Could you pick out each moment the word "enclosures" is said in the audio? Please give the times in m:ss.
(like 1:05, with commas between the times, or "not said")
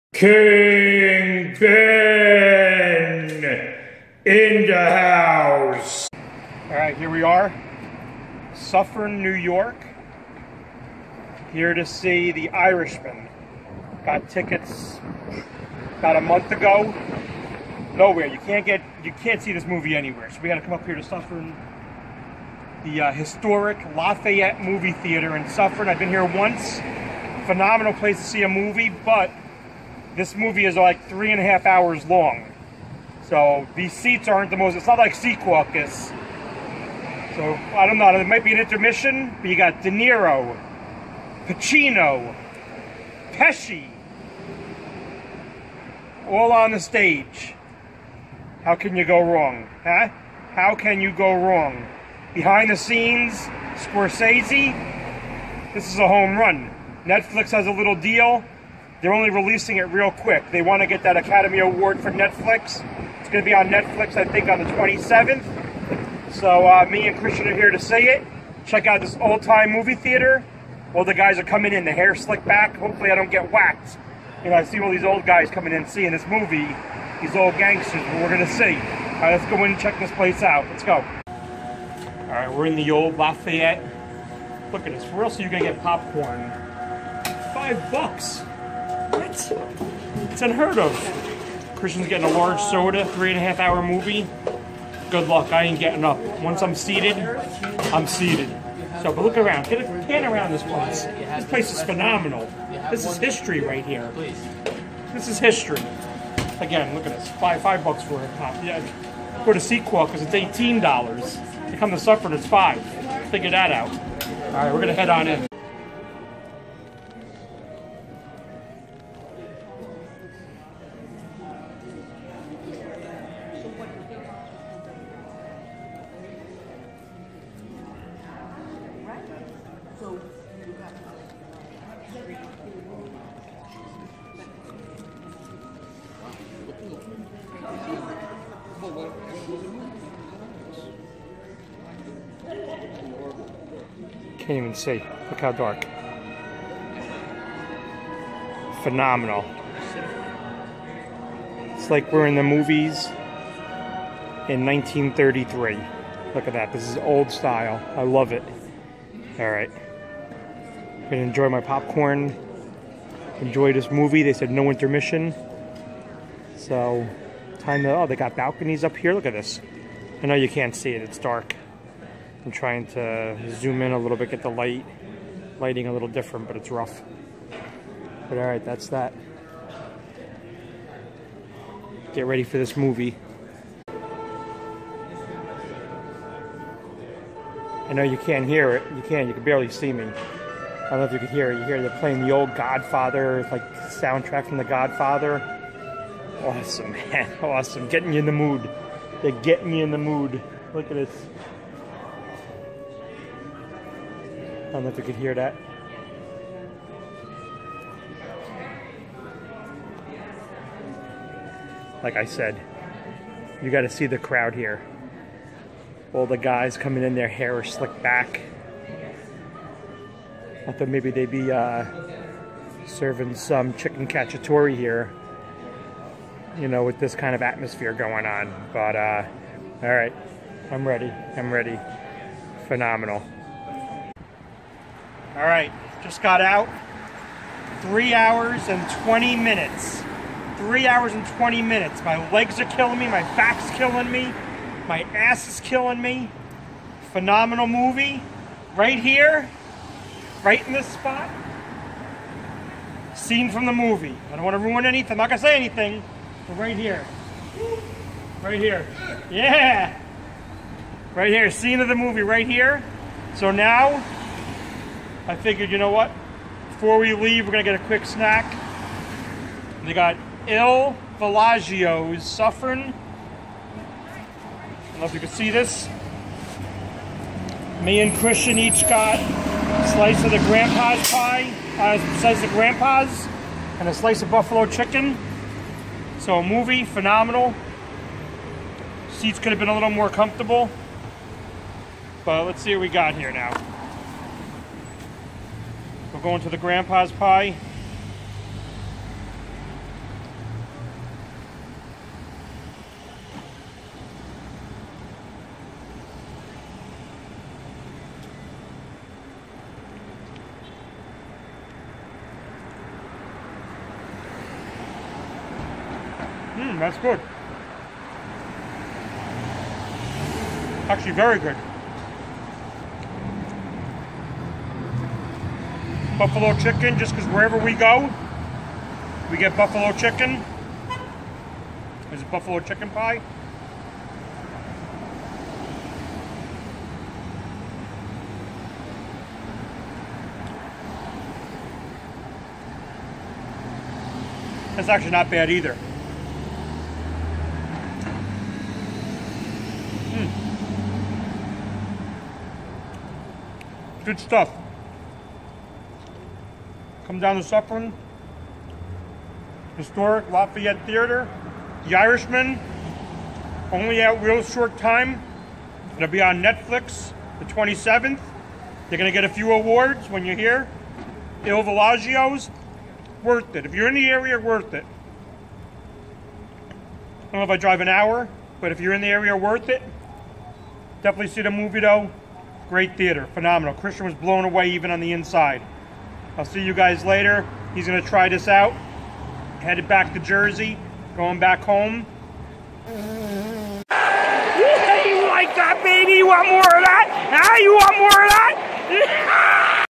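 not said.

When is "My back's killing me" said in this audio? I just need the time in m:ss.
4:03.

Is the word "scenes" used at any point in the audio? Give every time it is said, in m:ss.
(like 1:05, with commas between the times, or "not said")
0:52, 4:13, 4:21.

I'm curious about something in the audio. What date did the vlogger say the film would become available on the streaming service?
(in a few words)
the 27th.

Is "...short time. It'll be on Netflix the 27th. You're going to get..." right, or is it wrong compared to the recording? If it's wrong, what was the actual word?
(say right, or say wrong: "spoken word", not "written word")
right.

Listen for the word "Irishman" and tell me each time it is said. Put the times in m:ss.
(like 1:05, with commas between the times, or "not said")
0:12, 6:01.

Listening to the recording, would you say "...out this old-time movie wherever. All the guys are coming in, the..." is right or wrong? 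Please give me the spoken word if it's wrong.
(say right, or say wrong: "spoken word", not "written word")
wrong: "theater", not "wherever".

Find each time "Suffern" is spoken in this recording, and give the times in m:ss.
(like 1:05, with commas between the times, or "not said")
0:08, 0:21, 0:25, 1:51, 4:32, 5:57.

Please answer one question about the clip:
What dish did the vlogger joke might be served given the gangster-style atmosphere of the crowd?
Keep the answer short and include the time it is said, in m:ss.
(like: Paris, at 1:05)
chicken cacciatore, at 3:43.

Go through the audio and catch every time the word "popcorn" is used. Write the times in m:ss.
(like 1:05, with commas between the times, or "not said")
1:25, 2:41.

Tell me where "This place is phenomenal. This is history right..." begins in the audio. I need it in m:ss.
1:41.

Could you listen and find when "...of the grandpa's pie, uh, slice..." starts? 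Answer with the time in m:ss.
4:40.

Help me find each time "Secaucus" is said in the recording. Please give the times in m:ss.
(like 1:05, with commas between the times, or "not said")
0:35.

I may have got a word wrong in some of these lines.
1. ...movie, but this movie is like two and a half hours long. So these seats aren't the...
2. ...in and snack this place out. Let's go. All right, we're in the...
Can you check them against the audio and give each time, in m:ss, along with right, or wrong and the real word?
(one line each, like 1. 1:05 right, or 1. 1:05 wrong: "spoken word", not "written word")
1. 0:28 wrong: "three", not "two"
2. 1:19 wrong: "check", not "snack".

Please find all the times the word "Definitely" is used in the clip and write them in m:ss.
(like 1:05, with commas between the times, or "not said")
6:21.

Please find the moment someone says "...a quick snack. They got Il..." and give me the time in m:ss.
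4:27.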